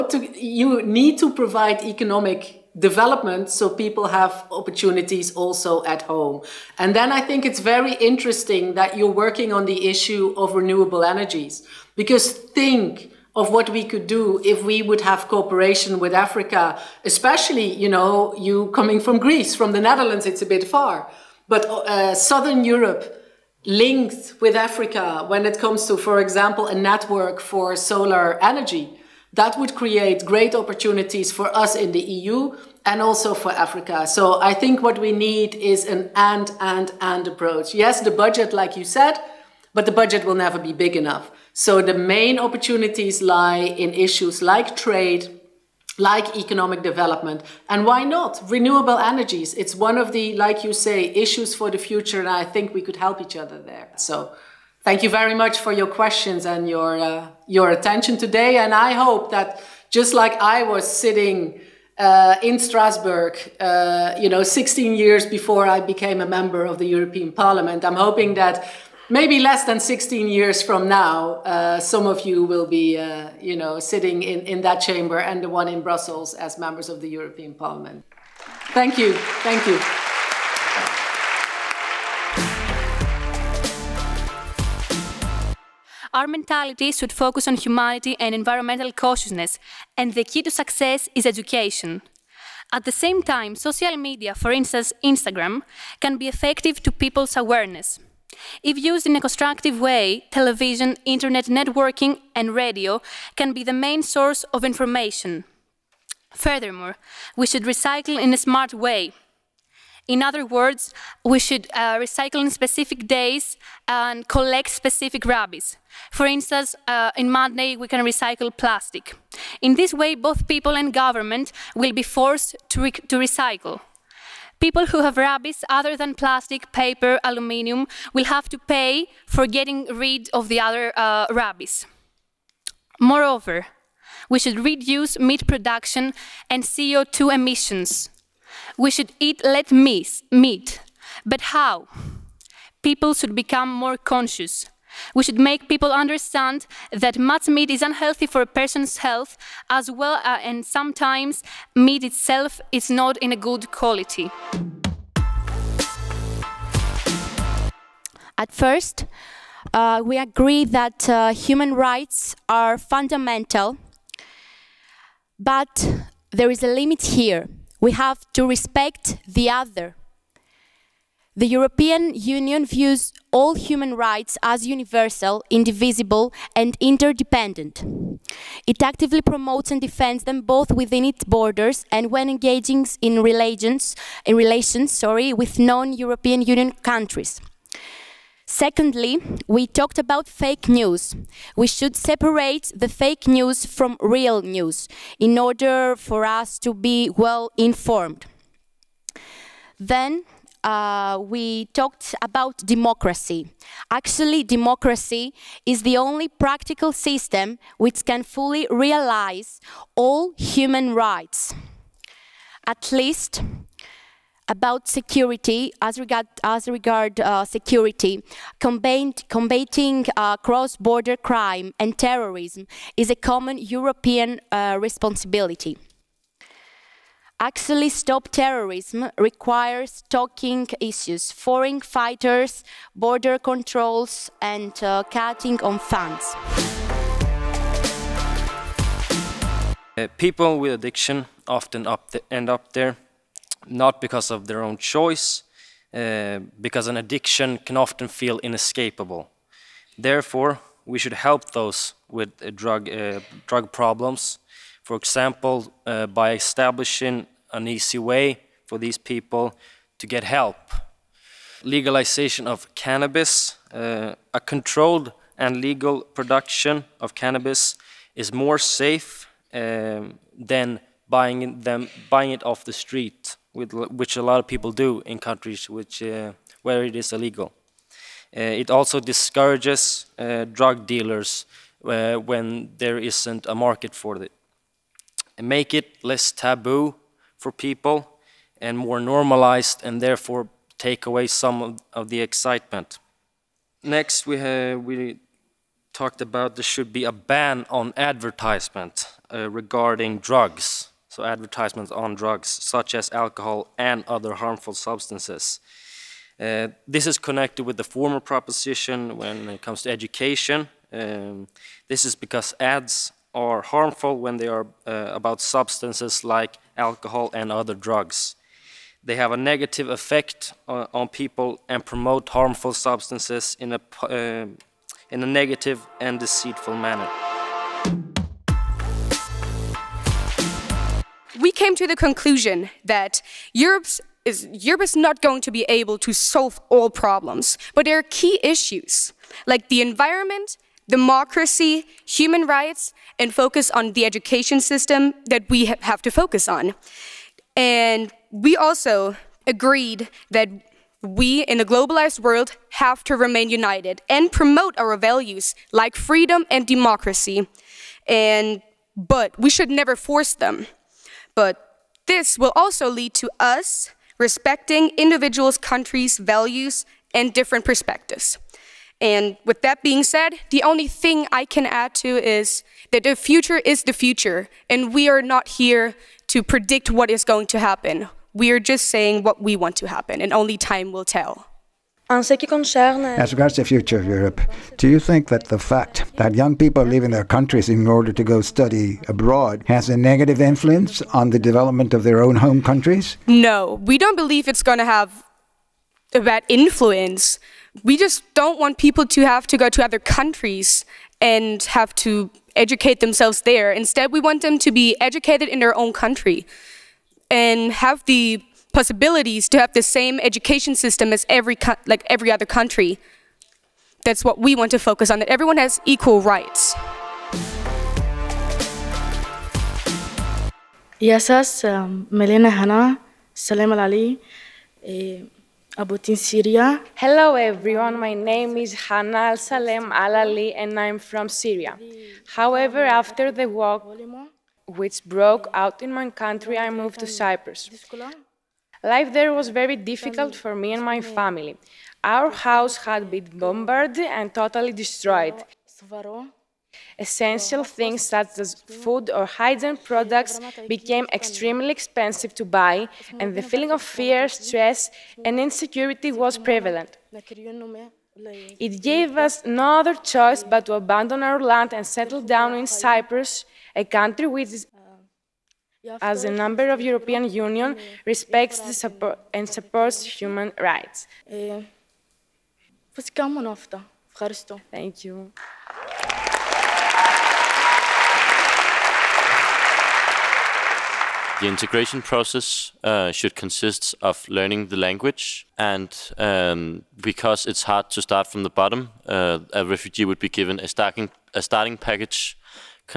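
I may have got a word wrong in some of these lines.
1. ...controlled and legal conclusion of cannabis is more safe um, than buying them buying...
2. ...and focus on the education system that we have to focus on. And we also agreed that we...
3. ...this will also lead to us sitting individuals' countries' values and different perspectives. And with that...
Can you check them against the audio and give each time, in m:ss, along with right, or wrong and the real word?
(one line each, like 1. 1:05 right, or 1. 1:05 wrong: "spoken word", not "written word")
1. 4:24 wrong: "production", not "conclusion"
2. 5:43 right
3. 6:02 wrong: "respecting", not "sitting".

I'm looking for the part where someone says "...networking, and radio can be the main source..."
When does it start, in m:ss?
1:41.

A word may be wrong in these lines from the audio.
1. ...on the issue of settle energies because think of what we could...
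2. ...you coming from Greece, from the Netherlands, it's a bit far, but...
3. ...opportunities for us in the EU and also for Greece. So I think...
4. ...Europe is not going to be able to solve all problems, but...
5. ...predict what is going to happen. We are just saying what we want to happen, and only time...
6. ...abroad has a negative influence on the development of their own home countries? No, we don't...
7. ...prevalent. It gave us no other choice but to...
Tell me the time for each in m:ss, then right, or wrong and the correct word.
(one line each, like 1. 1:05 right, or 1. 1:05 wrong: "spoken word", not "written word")
1. 0:09 wrong: "renewable", not "settle"
2. 0:18 right
3. 0:30 wrong: "Africa", not "Greece"
4. 5:34 right
5. 6:16 right
6. 6:29 right
7. 7:36 right.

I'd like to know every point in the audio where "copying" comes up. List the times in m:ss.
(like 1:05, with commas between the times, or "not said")
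not said.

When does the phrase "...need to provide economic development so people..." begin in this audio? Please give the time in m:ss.
0:00.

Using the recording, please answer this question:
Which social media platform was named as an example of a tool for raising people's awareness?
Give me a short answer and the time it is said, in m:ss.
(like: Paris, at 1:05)
Instagram, at 1:35.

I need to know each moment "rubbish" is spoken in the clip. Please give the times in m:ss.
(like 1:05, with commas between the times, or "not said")
1:55, 2:05, 2:11.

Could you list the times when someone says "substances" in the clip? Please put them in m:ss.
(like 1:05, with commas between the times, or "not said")
5:04, 5:15, 5:22.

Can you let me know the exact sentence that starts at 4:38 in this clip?
Uh, it also discourages uh, drug dealers uh, when there isn't a market for it.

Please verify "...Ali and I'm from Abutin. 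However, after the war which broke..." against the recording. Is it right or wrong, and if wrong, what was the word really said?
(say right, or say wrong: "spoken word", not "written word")
wrong: "Syria", not "Abutin".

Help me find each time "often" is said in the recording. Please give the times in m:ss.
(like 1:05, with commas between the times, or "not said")
4:01, 4:07.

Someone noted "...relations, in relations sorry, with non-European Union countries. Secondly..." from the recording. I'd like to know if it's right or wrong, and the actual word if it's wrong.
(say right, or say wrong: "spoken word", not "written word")
right.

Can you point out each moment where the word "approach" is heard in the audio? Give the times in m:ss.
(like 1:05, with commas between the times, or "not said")
0:37.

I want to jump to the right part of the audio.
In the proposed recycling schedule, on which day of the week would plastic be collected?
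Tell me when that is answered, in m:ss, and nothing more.
1:57.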